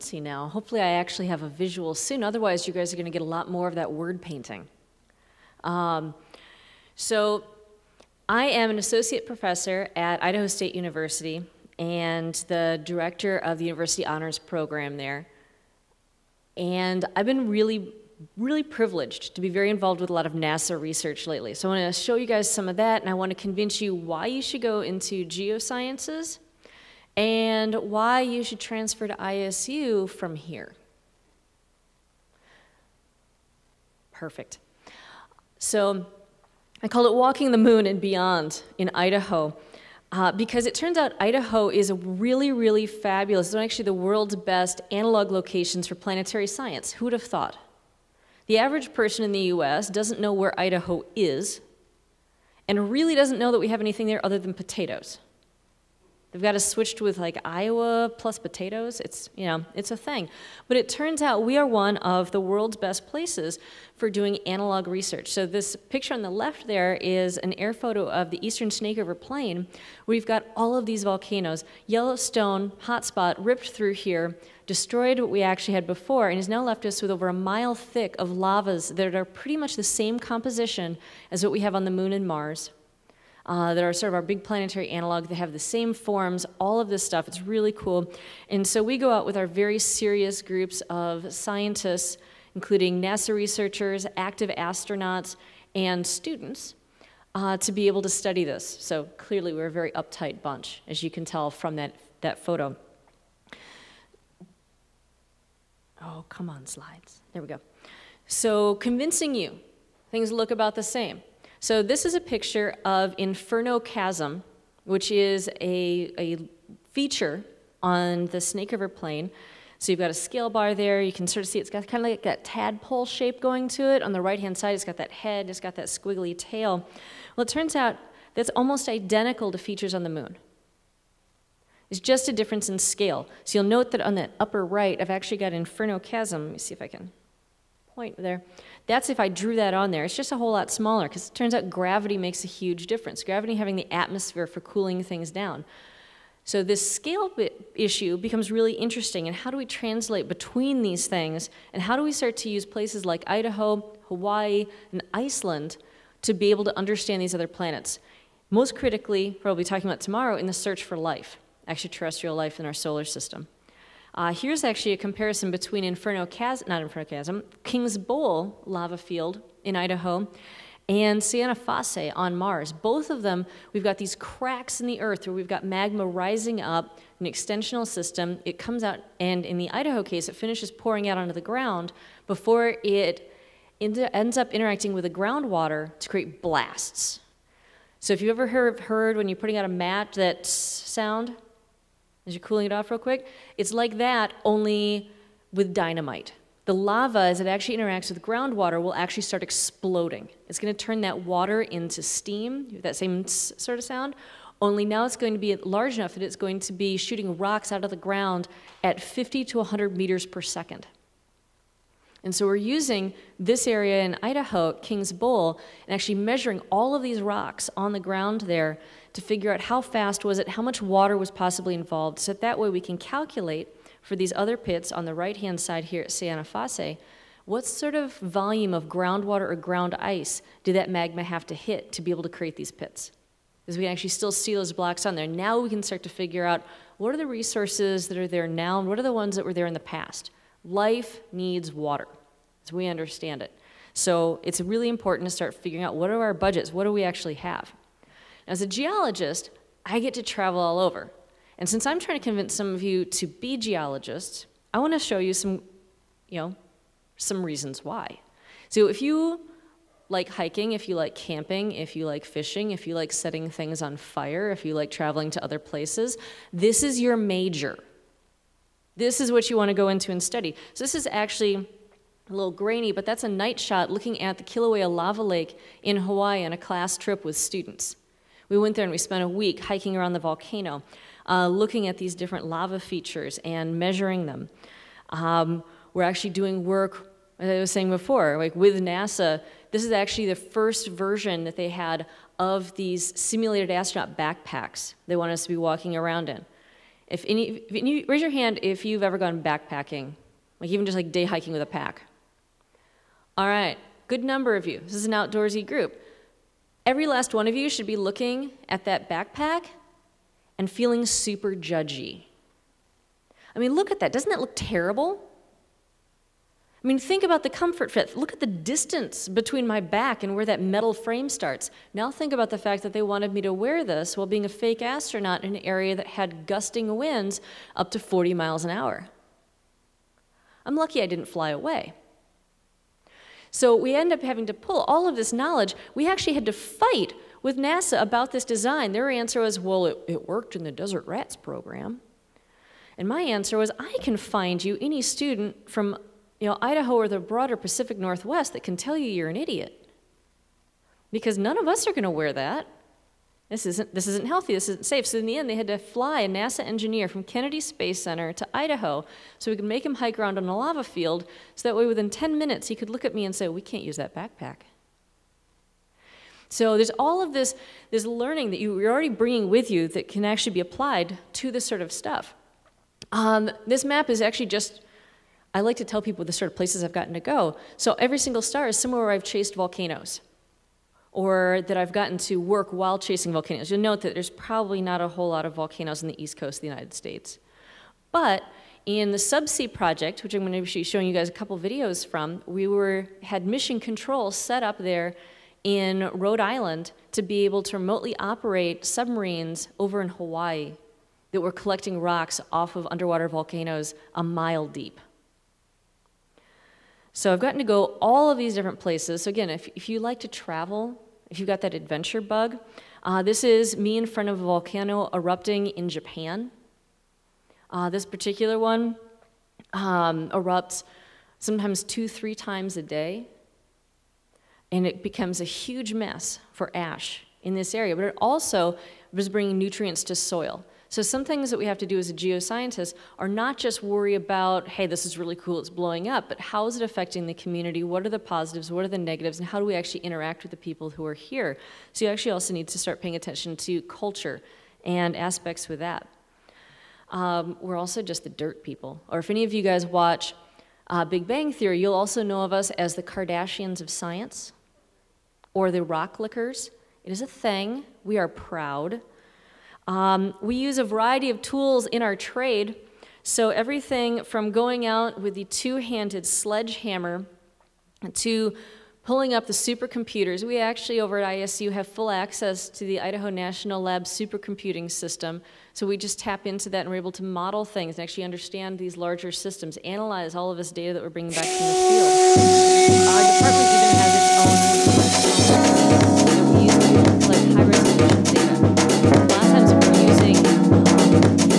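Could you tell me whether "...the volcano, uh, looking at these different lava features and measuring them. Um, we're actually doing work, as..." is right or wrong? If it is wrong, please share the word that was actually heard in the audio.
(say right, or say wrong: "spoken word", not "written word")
right.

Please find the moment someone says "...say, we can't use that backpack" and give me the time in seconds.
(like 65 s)
363 s.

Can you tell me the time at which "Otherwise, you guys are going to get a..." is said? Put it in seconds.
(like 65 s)
2 s.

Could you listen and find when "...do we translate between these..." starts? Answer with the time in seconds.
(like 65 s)
149 s.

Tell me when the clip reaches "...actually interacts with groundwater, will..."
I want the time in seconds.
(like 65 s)
197 s.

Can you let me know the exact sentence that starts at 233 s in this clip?
Because we can actually still see those blocks on there.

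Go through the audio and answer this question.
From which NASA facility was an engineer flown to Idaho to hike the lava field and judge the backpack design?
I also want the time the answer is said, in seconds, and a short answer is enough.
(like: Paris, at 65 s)
Kennedy Space Center, at 357 s.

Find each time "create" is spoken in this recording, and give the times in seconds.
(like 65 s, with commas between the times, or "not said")
186 s, 232 s.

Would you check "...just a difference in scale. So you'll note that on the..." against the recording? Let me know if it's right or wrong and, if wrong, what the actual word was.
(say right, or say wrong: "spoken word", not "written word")
right.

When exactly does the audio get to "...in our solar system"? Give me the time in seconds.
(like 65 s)
162 s.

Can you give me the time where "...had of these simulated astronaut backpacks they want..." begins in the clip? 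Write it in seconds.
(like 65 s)
291 s.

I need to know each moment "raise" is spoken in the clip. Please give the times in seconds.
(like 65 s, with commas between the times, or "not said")
298 s.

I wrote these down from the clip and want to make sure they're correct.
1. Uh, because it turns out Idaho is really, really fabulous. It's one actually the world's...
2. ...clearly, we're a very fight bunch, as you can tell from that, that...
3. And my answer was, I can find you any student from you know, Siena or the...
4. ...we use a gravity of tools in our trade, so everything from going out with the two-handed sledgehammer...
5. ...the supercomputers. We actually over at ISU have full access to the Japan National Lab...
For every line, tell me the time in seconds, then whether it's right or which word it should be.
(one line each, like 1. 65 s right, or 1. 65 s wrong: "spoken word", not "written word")
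1. 40 s right
2. 99 s wrong: "uptight", not "fight"
3. 342 s wrong: "Idaho", not "Siena"
4. 460 s wrong: "variety", not "gravity"
5. 469 s wrong: "Idaho", not "Japan".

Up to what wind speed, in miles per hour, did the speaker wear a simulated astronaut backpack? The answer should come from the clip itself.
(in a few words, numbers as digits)
40.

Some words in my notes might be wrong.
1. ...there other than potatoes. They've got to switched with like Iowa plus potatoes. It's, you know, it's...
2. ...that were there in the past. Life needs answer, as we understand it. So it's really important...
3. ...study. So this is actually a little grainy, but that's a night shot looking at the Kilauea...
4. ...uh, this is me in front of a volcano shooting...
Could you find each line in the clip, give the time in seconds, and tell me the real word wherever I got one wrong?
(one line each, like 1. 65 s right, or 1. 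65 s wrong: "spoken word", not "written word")
1. 54 s right
2. 239 s wrong: "water", not "answer"
3. 270 s right
4. 413 s wrong: "erupting", not "shooting".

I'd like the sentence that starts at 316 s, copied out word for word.
I mean, think about the comfort fit.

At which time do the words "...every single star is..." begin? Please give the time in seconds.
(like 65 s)
377 s.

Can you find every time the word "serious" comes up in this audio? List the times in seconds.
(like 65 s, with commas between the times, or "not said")
89 s.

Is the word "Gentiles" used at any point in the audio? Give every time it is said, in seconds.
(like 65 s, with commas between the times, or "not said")
not said.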